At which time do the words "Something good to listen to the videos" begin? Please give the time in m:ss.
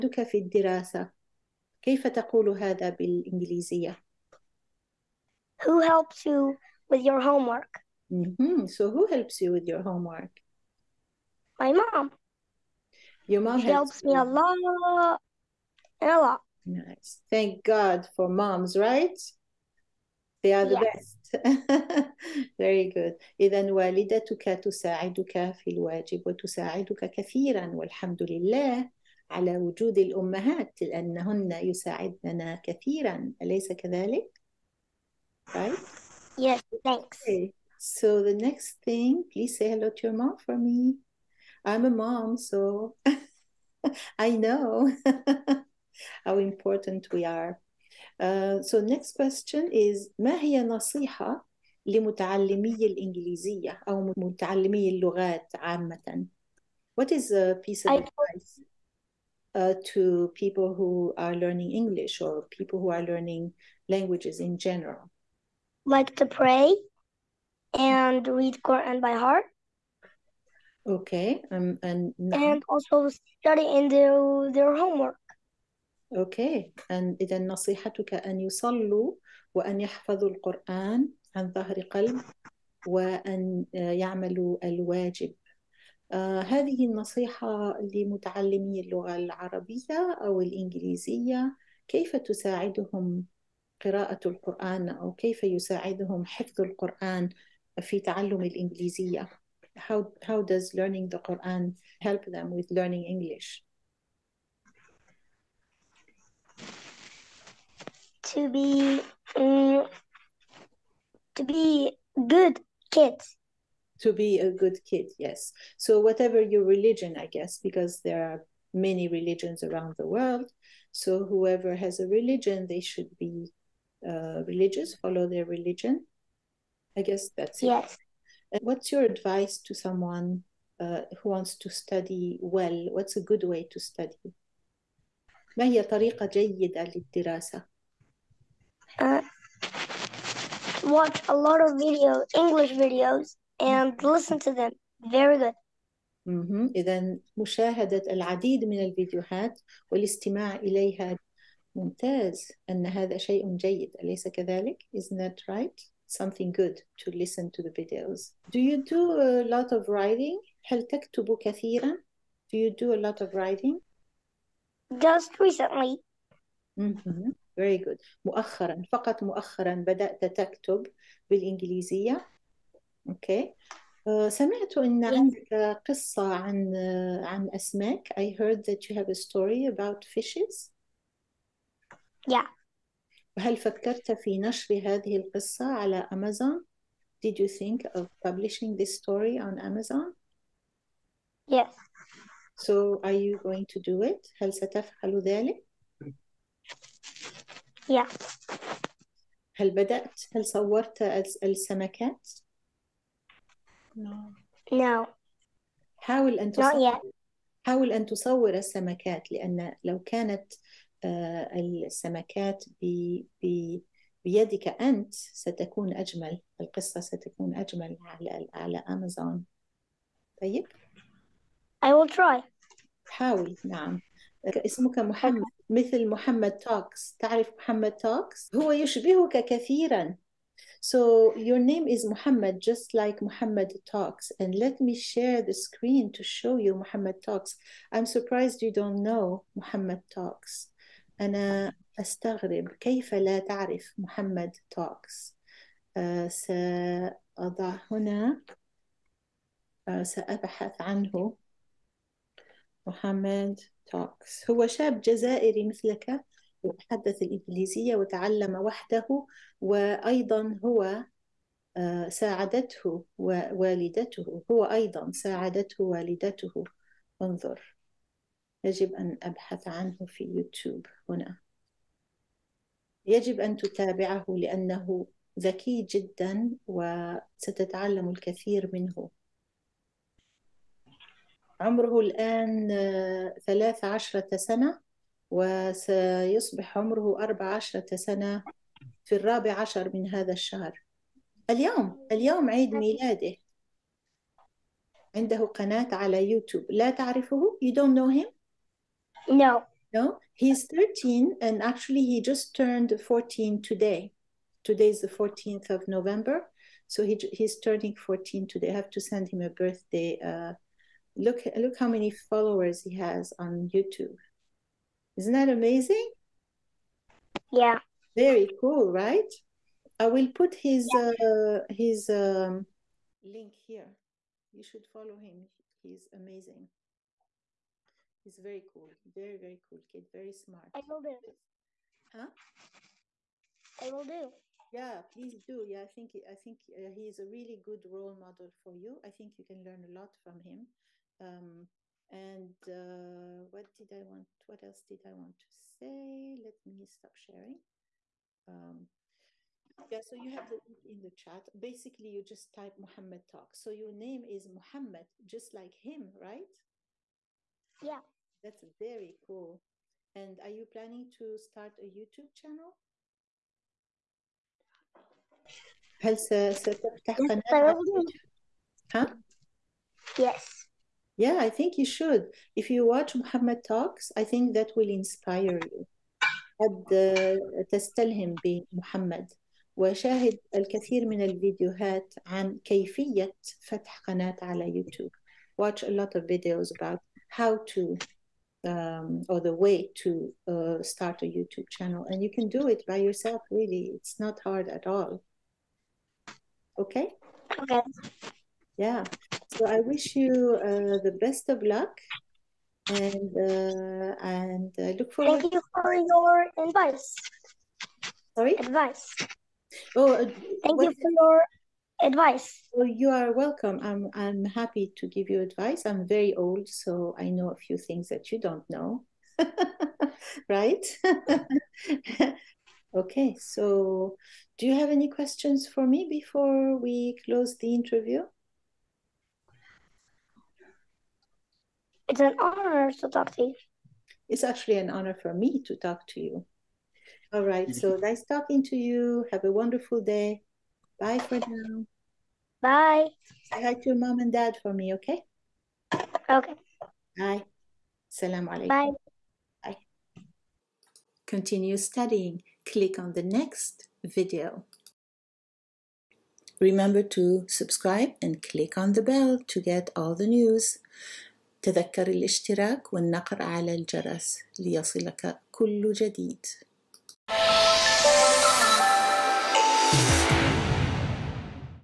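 2:36.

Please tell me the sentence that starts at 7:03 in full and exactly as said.
So, do you have any questions for me before we close the interview?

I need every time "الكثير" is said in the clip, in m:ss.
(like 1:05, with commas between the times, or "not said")
4:38, 6:20.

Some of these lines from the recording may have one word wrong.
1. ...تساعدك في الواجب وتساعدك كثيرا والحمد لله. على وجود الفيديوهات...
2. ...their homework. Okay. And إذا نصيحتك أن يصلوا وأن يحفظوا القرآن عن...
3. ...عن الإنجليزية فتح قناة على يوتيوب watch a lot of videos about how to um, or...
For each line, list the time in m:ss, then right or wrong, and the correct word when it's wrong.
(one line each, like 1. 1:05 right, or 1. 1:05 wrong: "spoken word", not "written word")
1. 0:24 wrong: "الأمهات", not "الفيديوهات"
2. 1:14 right
3. 6:22 wrong: "كيفية", not "الإنجليزية".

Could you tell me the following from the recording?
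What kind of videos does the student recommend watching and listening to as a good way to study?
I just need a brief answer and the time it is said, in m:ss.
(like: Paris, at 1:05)
English videos, at 2:22.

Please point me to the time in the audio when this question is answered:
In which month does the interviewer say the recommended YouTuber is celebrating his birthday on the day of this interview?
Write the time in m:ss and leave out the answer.
5:05.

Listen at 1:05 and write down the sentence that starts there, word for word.
Like to pray and read Quran by heart.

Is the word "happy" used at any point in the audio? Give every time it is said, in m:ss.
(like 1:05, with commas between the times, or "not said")
6:54.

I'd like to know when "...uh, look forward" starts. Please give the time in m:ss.
6:44.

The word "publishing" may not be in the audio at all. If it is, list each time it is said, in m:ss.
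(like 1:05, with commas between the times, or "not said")
3:08.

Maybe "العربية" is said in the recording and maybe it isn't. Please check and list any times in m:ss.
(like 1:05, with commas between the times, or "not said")
1:29.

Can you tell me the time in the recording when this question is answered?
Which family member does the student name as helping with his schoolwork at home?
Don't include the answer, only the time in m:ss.
0:11.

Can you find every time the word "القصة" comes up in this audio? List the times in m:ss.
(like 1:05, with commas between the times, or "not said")
3:05, 3:36.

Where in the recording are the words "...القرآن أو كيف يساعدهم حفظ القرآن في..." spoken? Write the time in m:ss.
1:34.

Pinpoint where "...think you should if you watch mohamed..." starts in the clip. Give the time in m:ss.
6:11.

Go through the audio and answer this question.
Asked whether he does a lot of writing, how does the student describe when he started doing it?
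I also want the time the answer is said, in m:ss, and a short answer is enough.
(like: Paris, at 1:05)
Just recently, at 2:45.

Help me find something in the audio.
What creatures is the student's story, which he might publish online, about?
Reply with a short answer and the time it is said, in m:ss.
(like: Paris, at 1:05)
Fishes, at 3:00.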